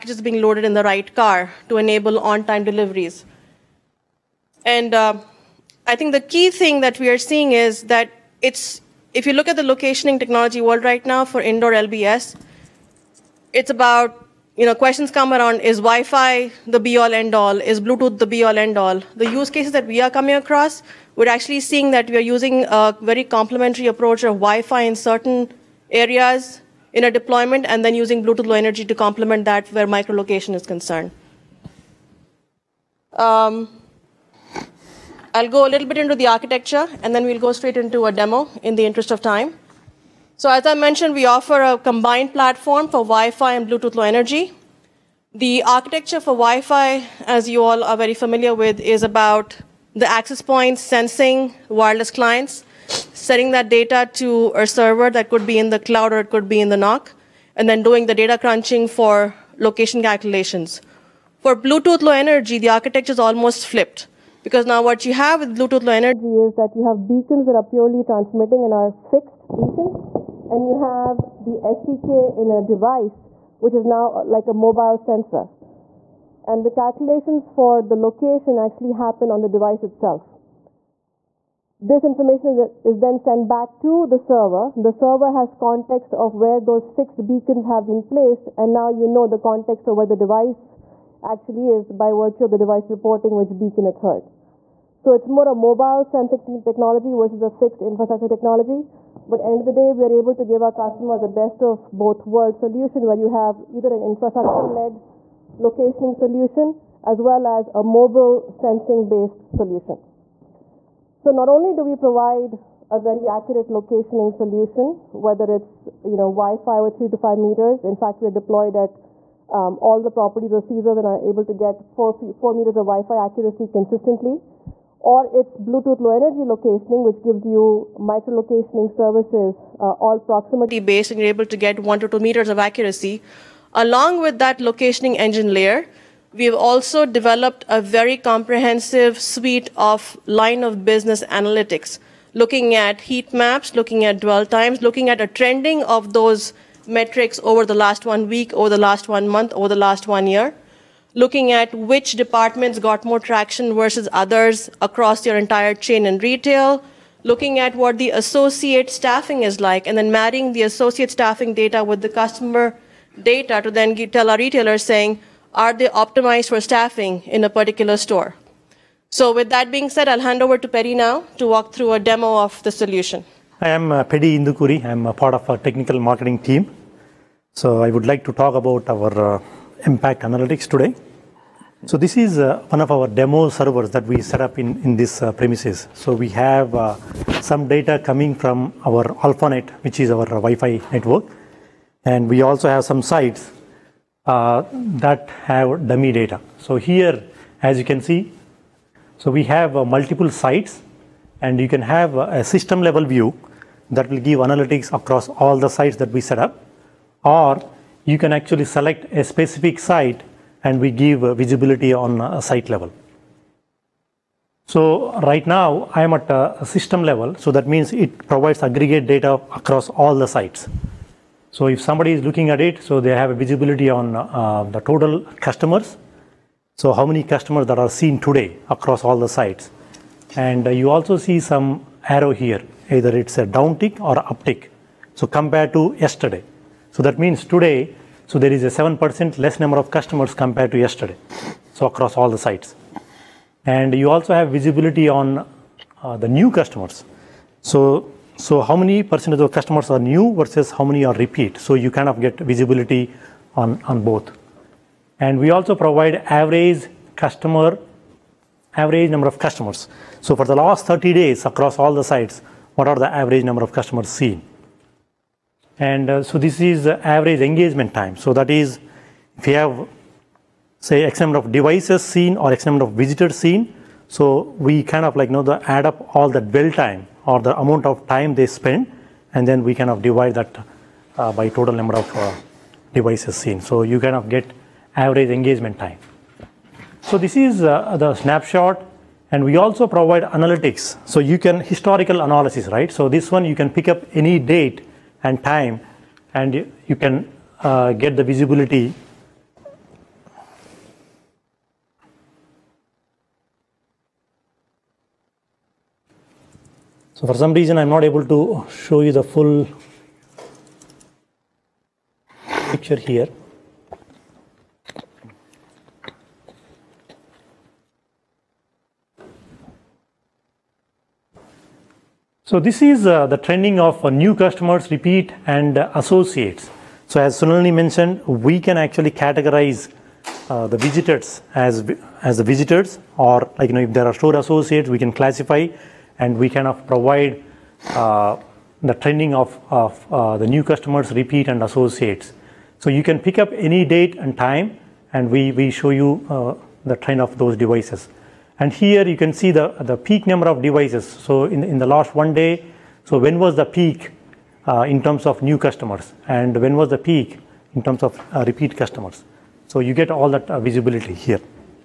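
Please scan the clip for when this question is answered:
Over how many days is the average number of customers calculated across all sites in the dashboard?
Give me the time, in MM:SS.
04:20.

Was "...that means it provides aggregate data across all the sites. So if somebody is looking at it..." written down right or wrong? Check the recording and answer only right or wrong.
right.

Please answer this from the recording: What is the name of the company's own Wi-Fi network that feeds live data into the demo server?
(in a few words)
AlphaNet.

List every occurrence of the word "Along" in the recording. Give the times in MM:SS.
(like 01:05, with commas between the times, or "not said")
02:13.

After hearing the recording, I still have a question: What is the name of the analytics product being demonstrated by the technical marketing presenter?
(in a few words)
MPact Analytics.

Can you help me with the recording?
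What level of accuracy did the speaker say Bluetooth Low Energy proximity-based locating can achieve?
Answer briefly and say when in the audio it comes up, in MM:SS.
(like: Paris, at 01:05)
1 to 2 meters, at 02:11.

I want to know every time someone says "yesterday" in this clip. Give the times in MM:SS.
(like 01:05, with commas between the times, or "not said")
03:55, 04:00.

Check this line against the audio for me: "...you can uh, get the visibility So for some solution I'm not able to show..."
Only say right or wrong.
wrong.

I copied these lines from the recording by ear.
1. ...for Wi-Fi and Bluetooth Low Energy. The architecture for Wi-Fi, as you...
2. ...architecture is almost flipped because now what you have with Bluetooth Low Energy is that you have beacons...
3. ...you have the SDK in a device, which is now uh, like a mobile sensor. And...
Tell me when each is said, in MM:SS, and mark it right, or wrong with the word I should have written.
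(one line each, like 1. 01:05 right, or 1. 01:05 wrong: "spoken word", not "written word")
1. 00:42 right
2. 01:02 right
3. 01:10 right.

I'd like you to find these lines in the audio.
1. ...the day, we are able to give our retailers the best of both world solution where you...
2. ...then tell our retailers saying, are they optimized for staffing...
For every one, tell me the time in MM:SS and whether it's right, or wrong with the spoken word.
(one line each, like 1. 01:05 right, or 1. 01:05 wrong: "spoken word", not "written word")
1. 01:39 wrong: "customers", not "retailers"
2. 02:43 right.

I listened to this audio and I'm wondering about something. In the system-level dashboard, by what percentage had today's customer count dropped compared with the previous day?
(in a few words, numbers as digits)
7%.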